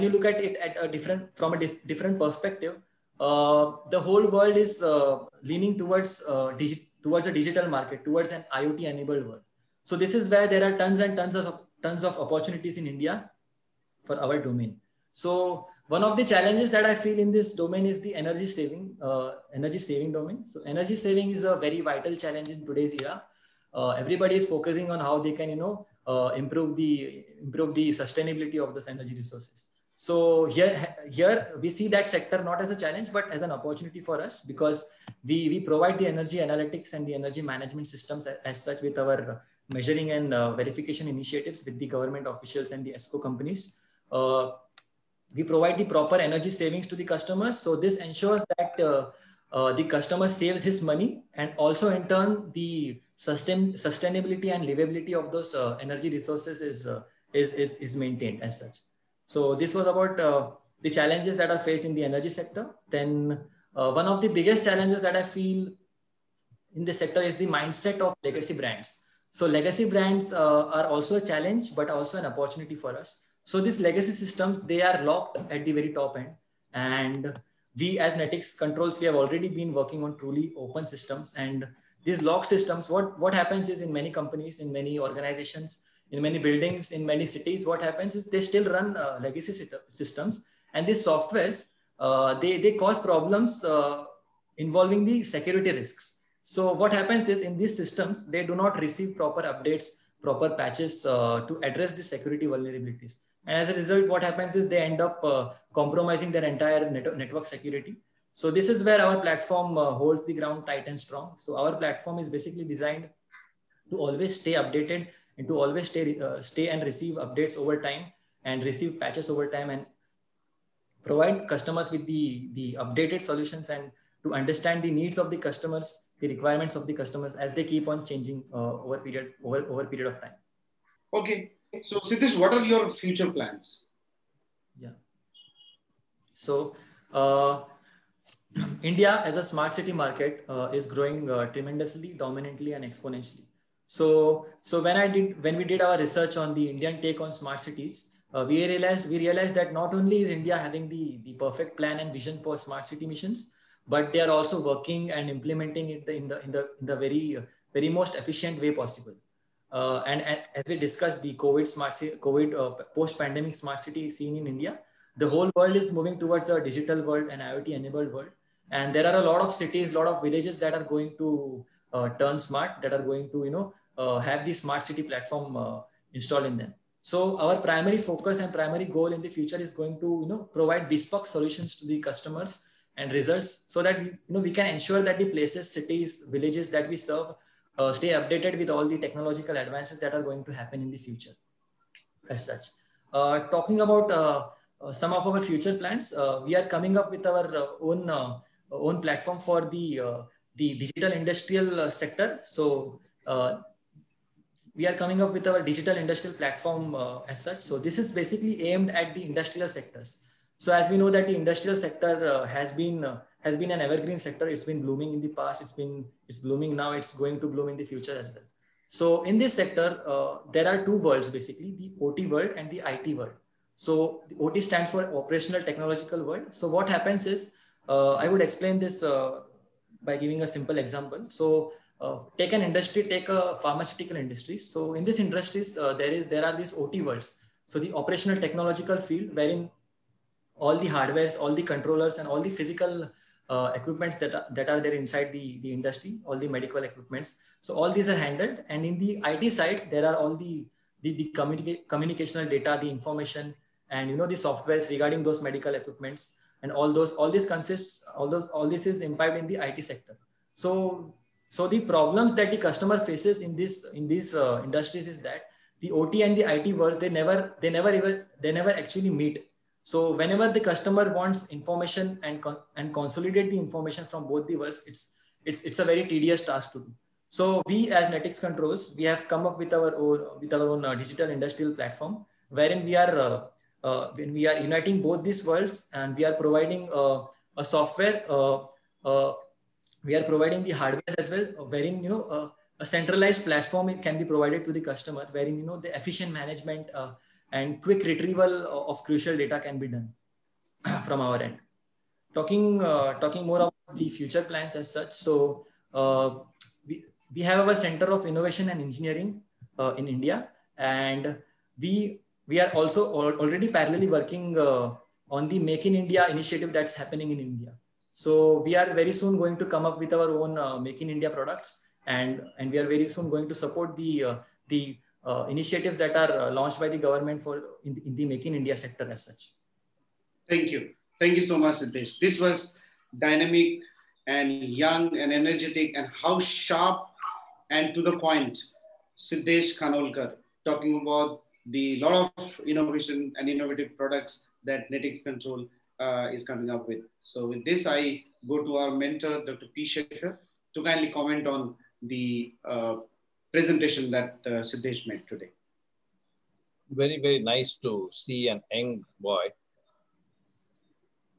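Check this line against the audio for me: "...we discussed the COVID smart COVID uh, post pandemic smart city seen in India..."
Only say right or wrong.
right.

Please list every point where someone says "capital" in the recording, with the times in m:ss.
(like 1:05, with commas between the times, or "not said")
not said.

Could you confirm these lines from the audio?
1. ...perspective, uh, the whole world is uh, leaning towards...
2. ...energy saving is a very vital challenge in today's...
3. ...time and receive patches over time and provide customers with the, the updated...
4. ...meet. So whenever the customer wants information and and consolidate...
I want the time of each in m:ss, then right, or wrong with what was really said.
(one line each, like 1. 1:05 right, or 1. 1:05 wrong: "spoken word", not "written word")
1. 0:02 right
2. 0:20 right
3. 1:57 right
4. 4:29 right.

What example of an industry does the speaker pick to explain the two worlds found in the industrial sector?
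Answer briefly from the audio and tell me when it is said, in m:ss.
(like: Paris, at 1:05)
pharmaceutical industry, at 3:53.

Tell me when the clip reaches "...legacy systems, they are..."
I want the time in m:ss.
1:13.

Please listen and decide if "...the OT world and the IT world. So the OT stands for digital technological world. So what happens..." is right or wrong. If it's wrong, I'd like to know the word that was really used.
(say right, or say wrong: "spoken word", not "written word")
wrong: "operational", not "digital".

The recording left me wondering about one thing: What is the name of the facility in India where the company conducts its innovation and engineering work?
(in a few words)
Center of Innovation and Engineering.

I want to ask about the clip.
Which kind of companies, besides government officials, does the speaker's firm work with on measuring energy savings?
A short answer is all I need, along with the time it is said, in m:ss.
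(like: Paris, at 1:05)
ESCO companies, at 0:42.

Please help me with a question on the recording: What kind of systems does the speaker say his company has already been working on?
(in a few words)
truly open systems.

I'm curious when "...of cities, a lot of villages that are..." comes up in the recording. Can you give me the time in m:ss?
2:49.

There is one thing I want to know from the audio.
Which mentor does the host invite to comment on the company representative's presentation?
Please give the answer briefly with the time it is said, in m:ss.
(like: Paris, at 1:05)
Dr. P. Sekhar, at 5:49.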